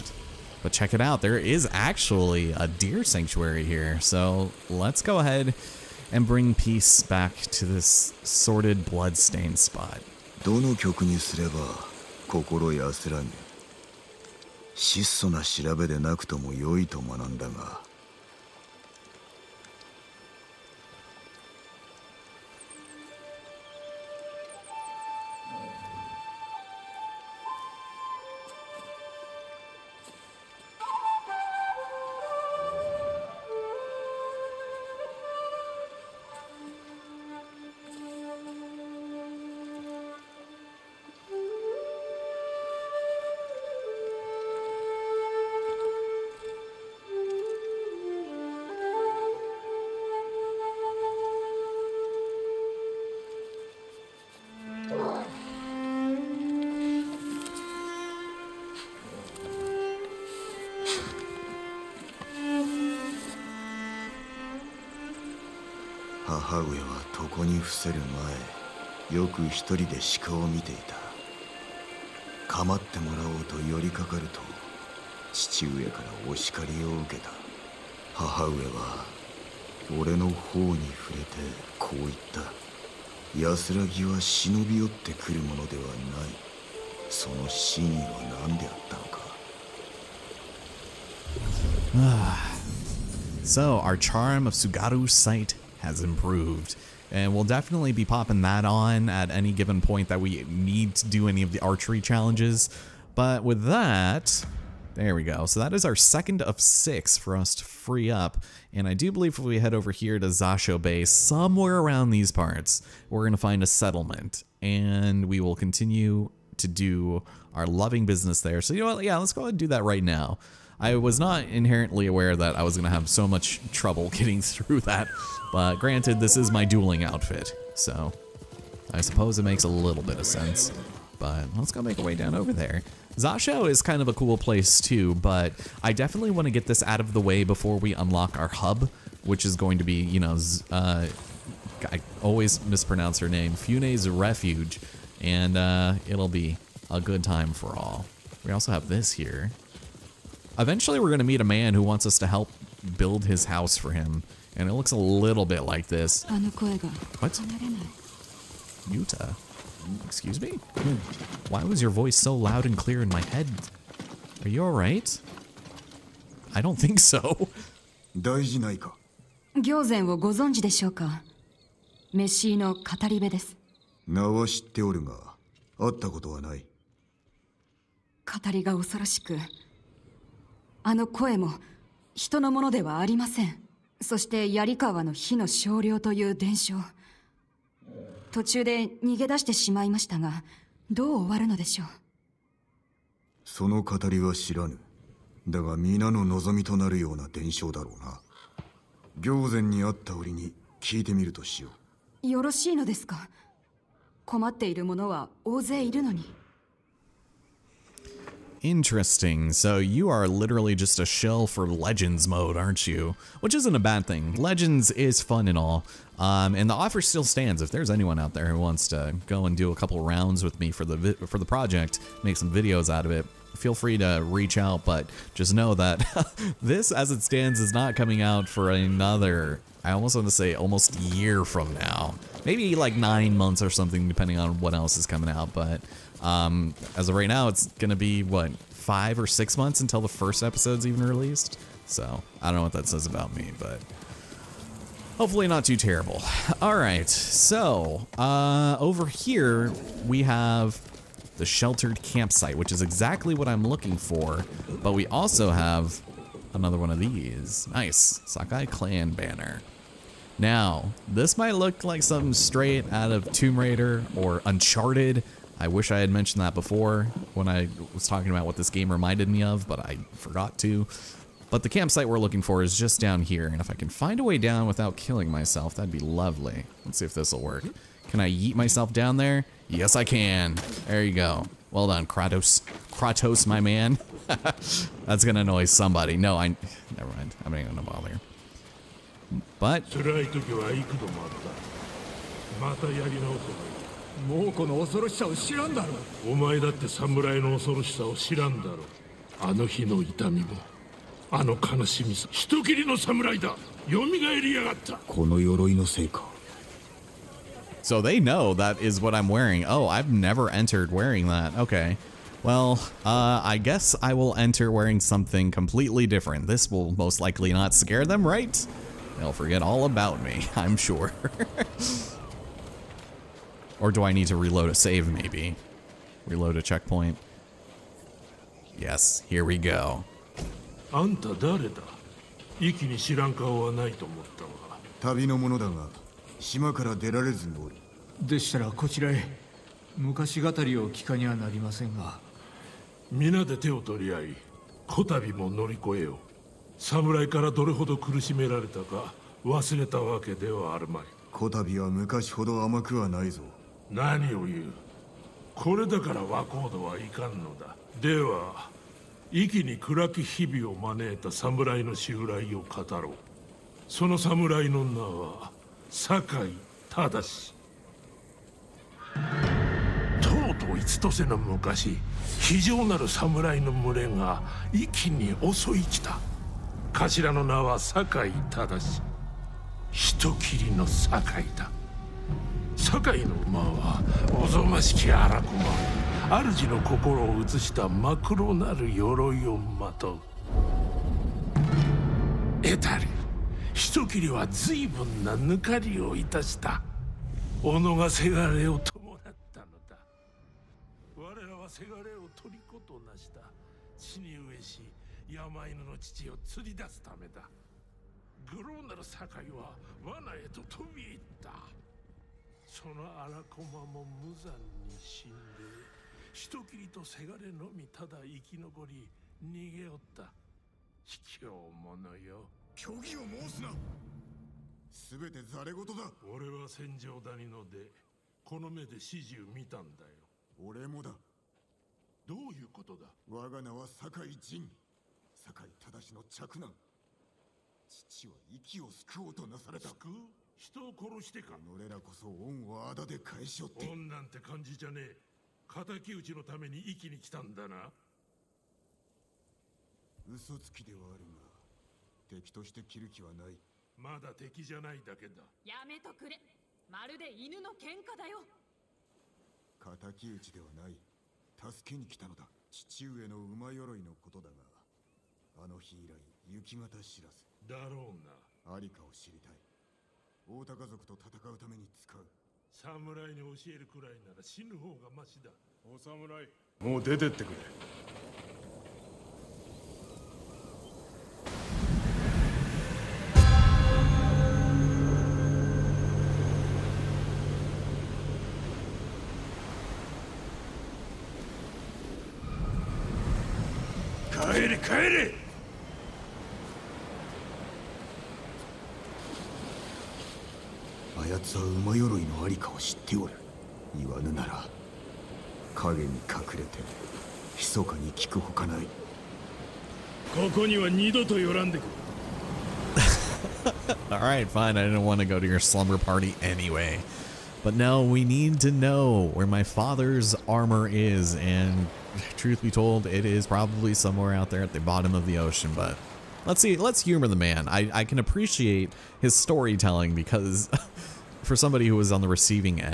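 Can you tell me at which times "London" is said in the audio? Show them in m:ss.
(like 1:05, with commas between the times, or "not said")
not said.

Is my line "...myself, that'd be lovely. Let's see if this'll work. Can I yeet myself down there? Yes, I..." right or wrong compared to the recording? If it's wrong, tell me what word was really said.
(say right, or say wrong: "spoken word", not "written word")
right.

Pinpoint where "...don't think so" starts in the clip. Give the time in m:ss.
2:46.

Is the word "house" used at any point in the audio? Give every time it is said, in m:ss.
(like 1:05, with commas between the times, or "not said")
2:33.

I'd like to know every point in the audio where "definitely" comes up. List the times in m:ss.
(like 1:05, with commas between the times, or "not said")
1:37, 2:15.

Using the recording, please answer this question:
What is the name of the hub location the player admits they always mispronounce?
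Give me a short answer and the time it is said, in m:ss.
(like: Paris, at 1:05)
Fune's Refuge, at 2:23.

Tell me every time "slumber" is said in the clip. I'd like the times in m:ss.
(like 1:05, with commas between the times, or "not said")
8:35.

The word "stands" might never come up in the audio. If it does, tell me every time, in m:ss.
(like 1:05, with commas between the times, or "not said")
3:37, 3:47.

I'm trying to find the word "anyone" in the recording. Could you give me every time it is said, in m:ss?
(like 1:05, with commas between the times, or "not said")
3:37.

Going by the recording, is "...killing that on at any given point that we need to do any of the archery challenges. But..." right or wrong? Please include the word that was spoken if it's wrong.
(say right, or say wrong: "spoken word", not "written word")
wrong: "popping", not "killing".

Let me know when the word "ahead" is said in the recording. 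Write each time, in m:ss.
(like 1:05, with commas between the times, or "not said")
0:05, 1:59.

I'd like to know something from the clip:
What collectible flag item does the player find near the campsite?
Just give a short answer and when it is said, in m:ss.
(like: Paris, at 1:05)
Sakai clan banner, at 4:18.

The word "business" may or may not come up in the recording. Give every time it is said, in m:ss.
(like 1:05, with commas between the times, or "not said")
1:58.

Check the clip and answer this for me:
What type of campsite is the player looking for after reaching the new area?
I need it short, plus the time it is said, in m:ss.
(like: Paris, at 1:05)
sheltered campsite, at 4:11.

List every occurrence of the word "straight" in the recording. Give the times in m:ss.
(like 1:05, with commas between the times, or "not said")
4:22.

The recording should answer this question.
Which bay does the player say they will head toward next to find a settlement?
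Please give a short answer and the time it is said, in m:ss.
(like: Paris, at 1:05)
Zasho Bay, at 1:50.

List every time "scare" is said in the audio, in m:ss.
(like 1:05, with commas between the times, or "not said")
5:17.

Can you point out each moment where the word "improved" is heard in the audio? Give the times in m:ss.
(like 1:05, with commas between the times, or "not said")
1:36.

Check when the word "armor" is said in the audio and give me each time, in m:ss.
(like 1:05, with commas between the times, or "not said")
8:40.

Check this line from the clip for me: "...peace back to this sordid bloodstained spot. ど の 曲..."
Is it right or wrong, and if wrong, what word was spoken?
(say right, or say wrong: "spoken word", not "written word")
right.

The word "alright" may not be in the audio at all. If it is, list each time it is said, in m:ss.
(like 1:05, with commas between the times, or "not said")
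2:44, 8:34.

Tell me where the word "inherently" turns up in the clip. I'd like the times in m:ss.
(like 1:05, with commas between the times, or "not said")
2:01.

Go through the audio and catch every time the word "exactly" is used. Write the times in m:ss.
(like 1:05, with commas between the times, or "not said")
4:12.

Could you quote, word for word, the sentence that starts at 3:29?
So you are literally just a shell for Legends mode, aren't you?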